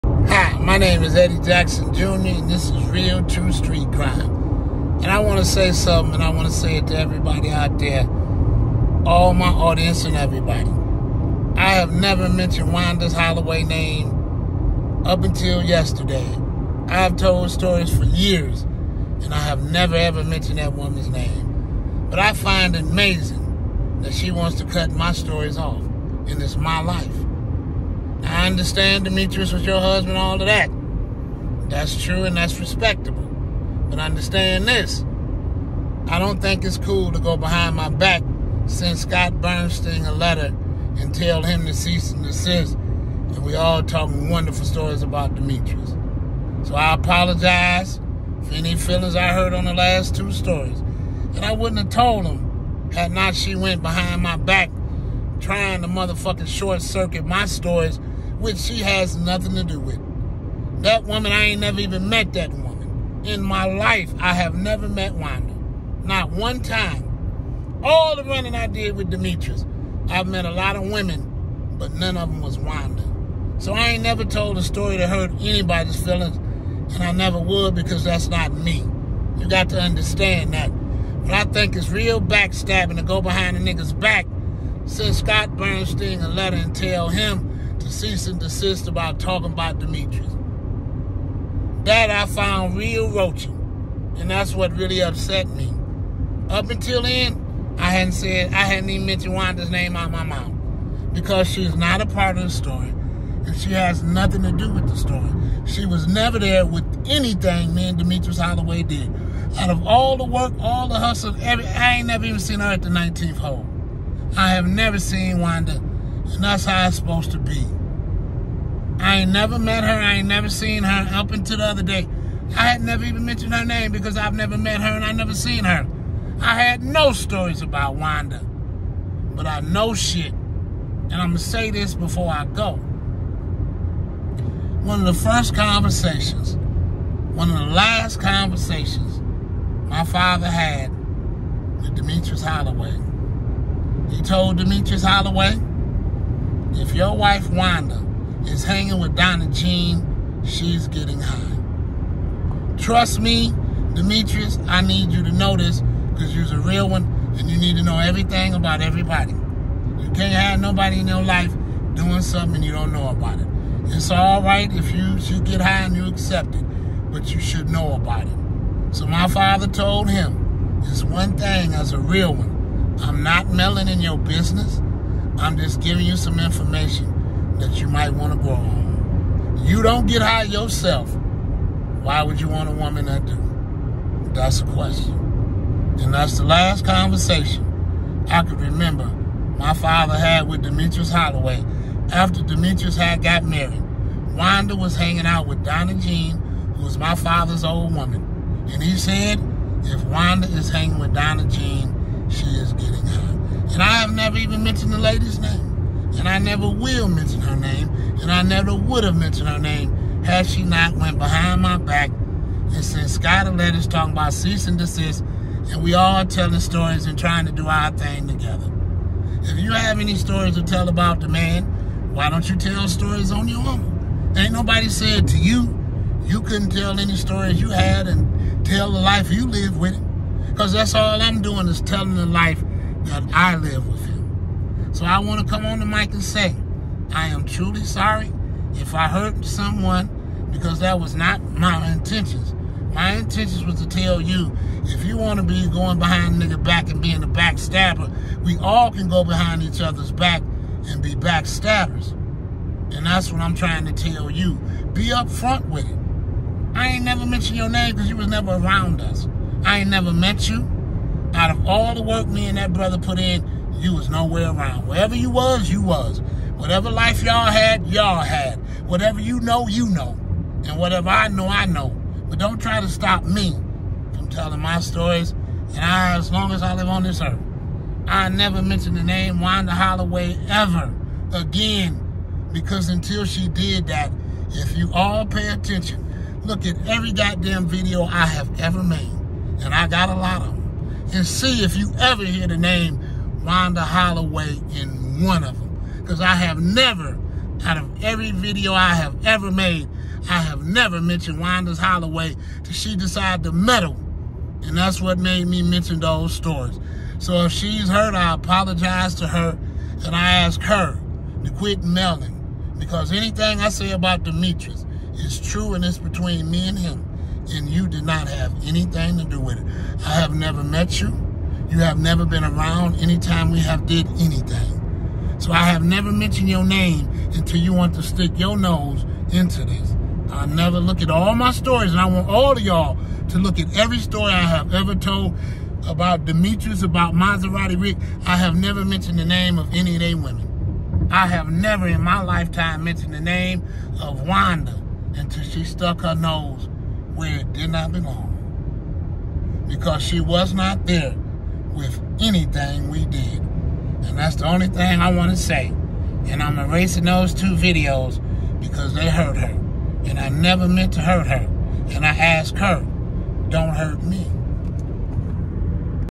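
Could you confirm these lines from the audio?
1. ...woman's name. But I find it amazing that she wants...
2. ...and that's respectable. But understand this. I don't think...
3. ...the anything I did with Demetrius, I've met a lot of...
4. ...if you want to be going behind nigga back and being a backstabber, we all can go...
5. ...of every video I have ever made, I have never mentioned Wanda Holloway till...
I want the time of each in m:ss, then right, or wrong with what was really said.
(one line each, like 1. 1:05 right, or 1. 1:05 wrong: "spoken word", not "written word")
1. 0:20 right
2. 0:32 right
3. 1:08 wrong: "running", not "anything"
4. 4:04 right
5. 4:57 right.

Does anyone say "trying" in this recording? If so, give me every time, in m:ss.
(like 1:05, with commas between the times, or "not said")
0:55, 3:37, 4:13.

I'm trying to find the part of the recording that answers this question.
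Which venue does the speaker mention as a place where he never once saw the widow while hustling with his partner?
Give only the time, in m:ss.
1:52.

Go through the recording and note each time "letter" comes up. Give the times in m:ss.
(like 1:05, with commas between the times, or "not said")
0:40, 1:26, 3:33.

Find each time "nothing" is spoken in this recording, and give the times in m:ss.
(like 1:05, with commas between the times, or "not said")
0:59, 1:44.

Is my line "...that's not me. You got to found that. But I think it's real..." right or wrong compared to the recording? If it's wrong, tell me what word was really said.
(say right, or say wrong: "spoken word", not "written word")
wrong: "understand", not "found".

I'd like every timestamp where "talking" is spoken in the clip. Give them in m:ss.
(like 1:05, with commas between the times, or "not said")
0:43, 1:29, 3:33.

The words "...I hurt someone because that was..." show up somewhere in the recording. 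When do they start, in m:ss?
3:58.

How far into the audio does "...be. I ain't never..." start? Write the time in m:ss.
1:57.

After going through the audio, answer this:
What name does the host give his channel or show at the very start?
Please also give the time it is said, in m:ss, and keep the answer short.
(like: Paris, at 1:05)
Real True Street Crime, at 0:02.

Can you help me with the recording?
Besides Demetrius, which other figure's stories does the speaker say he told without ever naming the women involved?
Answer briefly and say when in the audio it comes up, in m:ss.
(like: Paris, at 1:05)
Maserati Rick, at 5:37.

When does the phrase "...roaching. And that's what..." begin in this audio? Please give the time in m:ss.
1:33.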